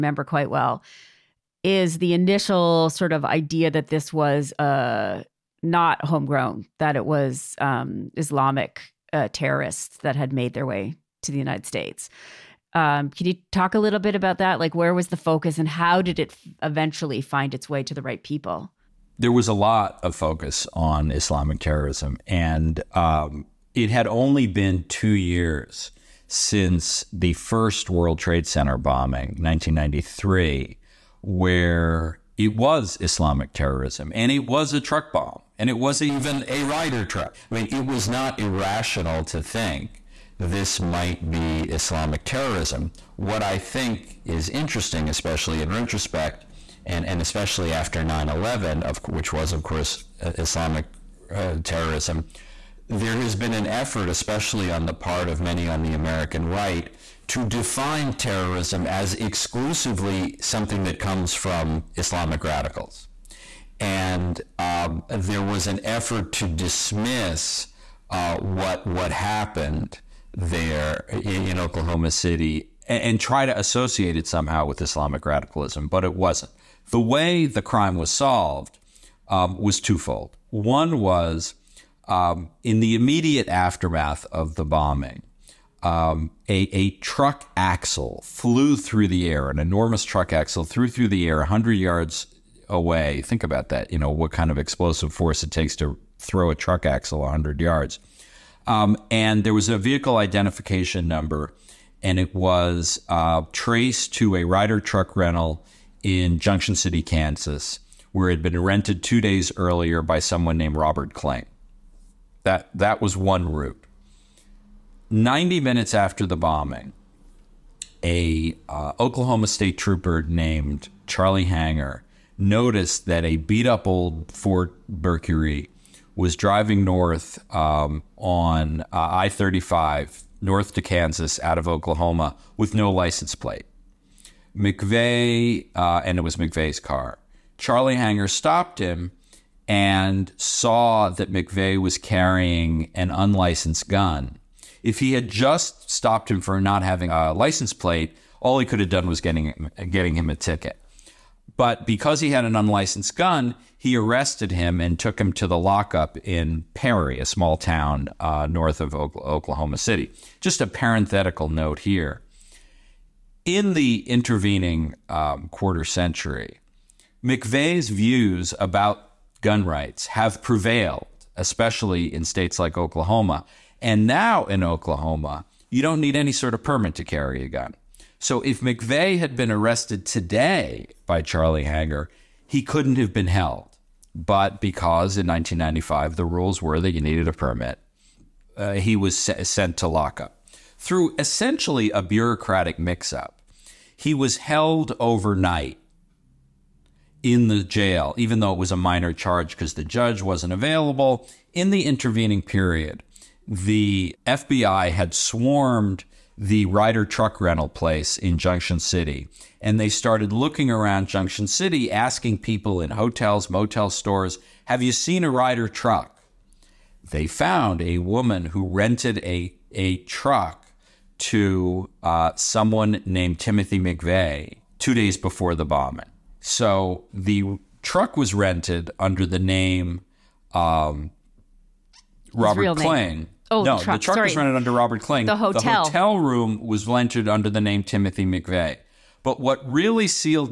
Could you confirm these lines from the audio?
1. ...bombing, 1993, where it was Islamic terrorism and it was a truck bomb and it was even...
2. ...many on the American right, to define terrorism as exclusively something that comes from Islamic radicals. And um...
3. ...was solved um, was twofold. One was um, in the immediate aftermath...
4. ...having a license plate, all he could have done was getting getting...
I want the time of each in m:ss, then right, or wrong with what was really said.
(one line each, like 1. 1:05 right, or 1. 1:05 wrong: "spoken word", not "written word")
1. 0:28 right
2. 0:55 right
3. 1:17 right
4. 2:26 right.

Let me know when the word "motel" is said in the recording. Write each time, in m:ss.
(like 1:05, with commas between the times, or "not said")
3:33.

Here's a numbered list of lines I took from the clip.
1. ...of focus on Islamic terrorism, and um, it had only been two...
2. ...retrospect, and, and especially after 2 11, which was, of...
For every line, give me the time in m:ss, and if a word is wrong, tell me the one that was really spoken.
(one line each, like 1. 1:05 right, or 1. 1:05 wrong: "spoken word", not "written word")
1. 0:20 right
2. 0:45 wrong: "9", not "2".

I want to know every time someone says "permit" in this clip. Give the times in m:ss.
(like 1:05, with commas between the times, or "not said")
2:56, 3:07.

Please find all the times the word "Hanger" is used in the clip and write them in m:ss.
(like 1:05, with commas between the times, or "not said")
2:01, 2:17, 3:01.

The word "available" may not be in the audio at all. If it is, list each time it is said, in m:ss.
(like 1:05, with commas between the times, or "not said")
3:20.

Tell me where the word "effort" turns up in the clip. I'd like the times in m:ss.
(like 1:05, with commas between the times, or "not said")
0:53, 1:05.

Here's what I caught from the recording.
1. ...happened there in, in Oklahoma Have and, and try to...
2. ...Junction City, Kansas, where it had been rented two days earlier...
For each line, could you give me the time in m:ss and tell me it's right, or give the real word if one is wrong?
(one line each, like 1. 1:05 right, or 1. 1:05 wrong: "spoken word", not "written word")
1. 1:09 wrong: "City", not "Have"
2. 1:46 right.